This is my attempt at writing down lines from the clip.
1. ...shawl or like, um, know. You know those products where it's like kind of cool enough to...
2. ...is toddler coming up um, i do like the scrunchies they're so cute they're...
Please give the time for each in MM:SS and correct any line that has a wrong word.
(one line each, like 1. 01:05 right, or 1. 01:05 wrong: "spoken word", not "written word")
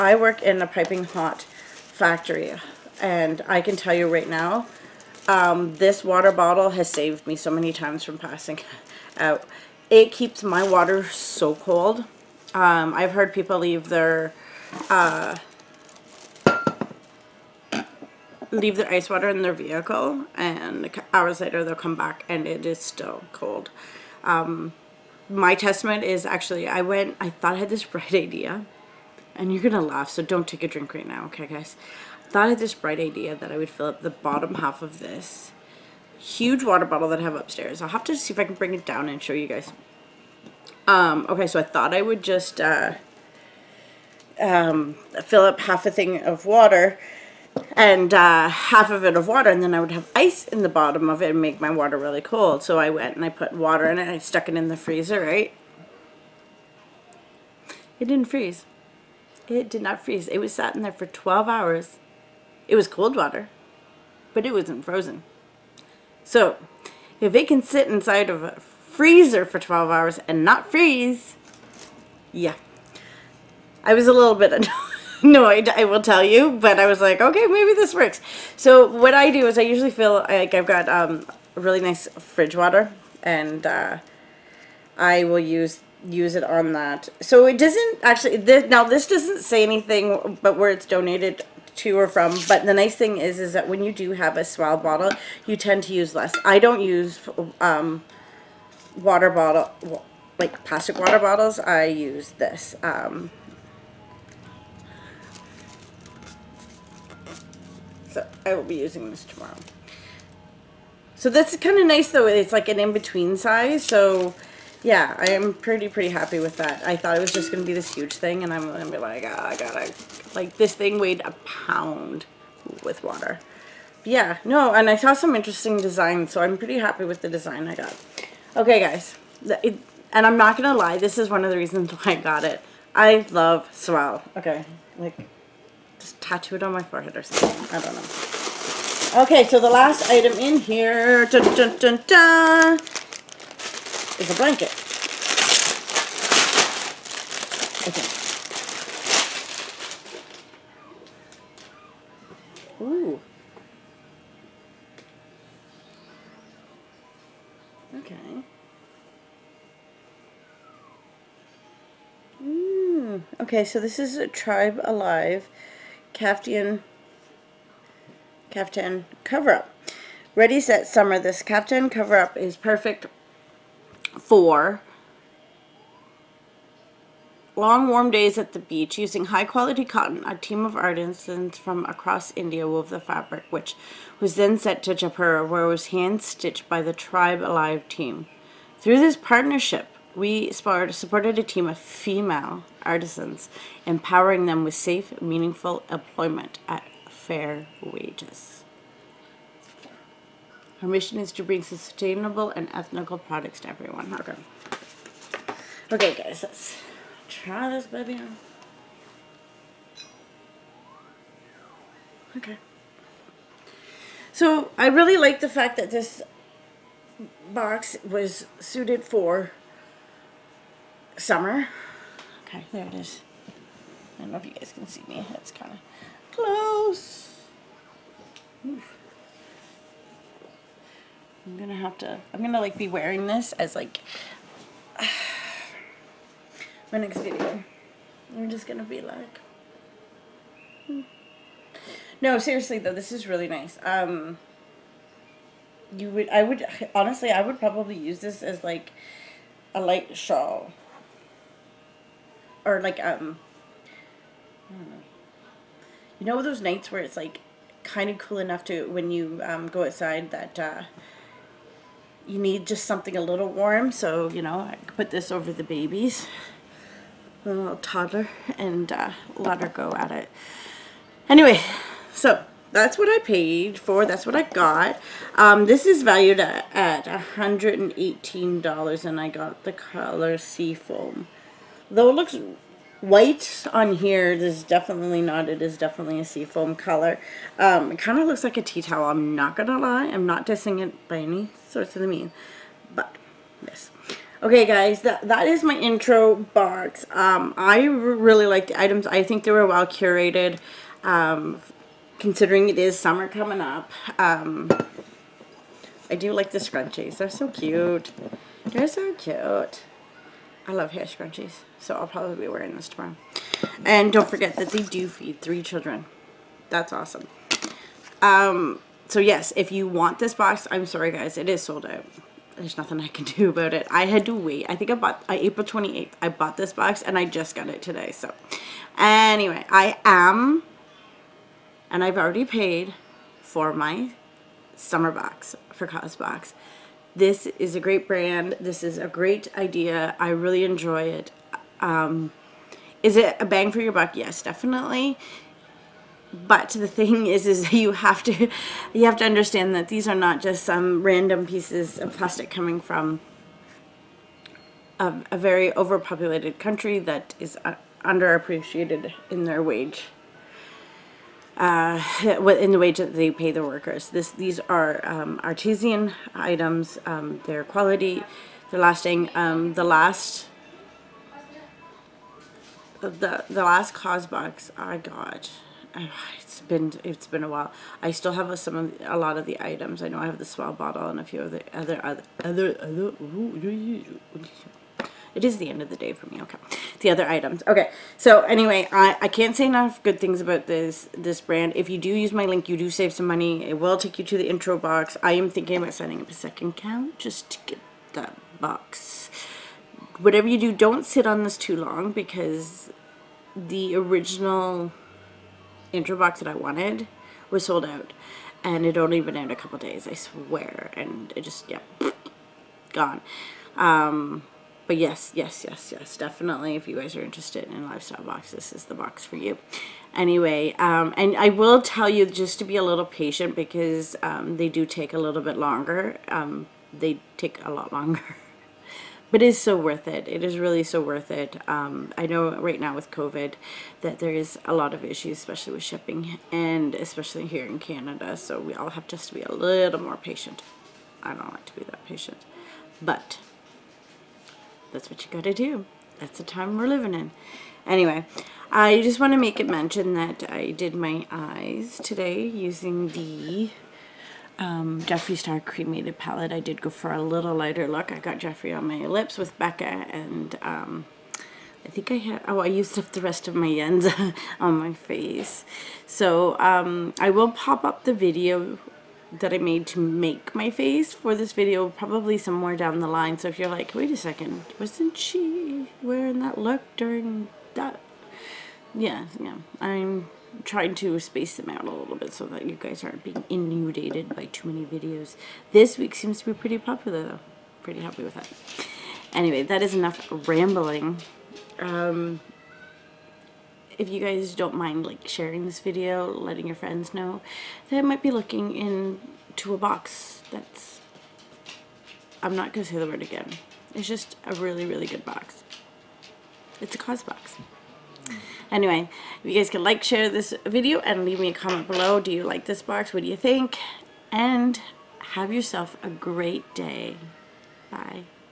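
1. 04:10 wrong: "nights", not "products"
2. 05:02 wrong: "summer", not "toddler".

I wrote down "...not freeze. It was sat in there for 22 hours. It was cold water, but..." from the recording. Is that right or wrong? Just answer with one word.
wrong.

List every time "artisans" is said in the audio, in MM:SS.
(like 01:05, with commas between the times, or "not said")
03:00, 03:12, 06:05.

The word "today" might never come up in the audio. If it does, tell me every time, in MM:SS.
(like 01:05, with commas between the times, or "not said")
05:27, 07:32.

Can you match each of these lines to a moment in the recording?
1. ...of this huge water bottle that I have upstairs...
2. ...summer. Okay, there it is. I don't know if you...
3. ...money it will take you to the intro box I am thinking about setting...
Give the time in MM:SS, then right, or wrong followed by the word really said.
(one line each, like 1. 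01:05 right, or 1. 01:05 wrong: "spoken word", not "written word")
1. 00:34 right
2. 03:41 right
3. 06:33 right.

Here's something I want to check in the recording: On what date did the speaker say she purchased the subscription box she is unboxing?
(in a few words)
April 28th.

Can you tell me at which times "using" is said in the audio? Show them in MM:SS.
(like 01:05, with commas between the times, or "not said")
01:48, 02:58, 07:32.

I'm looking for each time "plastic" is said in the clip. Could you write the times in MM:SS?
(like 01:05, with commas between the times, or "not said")
01:40, 05:52.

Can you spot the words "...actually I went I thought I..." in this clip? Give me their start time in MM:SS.
00:26.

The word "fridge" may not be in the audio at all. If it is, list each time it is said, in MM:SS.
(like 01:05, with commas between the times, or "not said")
01:22.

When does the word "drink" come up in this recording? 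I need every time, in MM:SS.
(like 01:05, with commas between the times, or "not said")
00:30.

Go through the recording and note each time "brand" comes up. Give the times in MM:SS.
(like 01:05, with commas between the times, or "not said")
05:38, 06:31.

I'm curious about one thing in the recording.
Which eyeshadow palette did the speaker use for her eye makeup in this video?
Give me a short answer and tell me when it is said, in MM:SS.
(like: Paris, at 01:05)
Jeffree Star Cremated, at 07:35.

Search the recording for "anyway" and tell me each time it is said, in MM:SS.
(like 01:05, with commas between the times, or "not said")
04:31, 05:28, 06:28, 07:00, 07:27, 08:09, 08:28.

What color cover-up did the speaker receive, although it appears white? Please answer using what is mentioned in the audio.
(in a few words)
sea foam.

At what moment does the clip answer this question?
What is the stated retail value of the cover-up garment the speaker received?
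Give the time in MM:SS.
04:37.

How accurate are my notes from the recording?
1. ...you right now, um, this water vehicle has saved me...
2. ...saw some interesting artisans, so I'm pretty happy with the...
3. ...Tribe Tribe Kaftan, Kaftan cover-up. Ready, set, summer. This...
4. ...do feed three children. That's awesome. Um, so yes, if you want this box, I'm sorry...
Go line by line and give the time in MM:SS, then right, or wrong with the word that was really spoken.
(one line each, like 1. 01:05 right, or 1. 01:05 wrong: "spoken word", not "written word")
1. 00:03 wrong: "bottle", not "vehicle"
2. 02:04 wrong: "designs", not "artisans"
3. 02:44 wrong: "Alive", not "Tribe"
4. 05:14 right.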